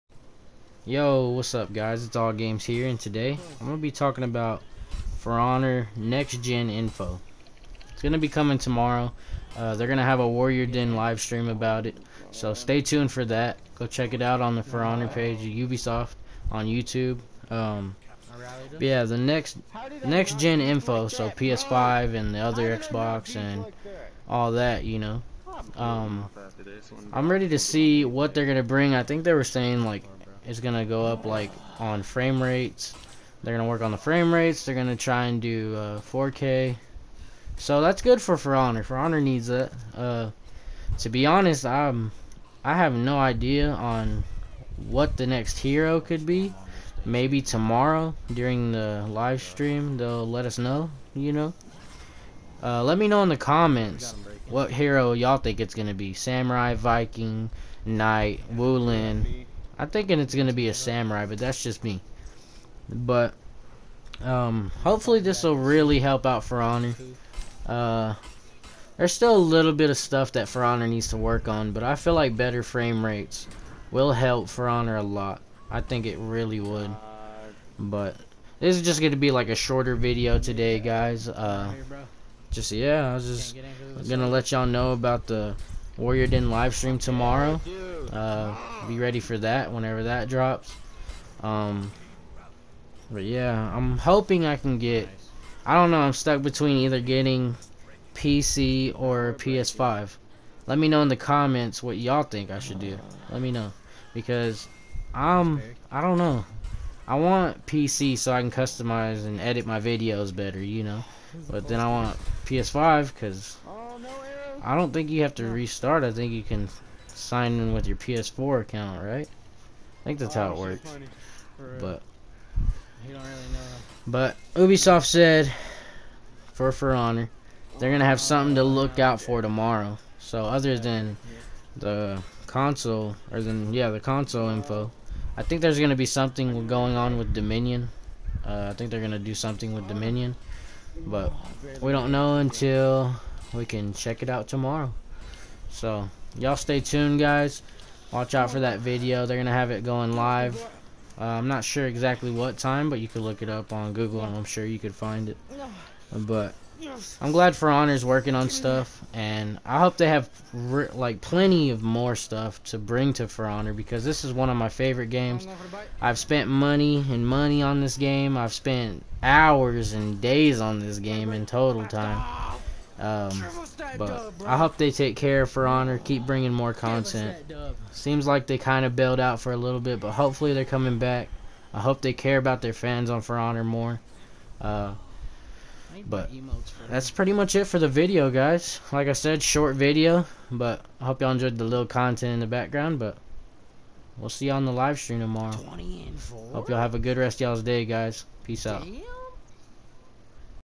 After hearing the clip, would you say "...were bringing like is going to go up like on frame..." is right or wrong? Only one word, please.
wrong.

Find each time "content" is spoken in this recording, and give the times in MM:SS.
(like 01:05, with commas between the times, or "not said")
02:56, 03:11.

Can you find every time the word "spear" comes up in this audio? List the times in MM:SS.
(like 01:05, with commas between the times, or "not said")
not said.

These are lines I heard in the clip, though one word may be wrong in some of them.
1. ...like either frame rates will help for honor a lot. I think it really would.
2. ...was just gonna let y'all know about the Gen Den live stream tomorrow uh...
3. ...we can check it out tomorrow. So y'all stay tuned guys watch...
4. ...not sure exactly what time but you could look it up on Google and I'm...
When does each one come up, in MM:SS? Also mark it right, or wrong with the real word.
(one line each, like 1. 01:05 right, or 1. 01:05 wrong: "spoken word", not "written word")
1. 01:12 wrong: "better", not "either"
2. 01:23 wrong: "Warrior", not "Gen"
3. 02:23 right
4. 02:31 right.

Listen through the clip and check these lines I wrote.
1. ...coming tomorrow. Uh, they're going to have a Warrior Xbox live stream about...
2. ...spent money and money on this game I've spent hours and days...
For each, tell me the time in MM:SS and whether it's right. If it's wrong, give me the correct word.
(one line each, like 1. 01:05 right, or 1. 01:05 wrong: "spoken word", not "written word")
1. 00:08 wrong: "Den", not "Xbox"
2. 02:46 right.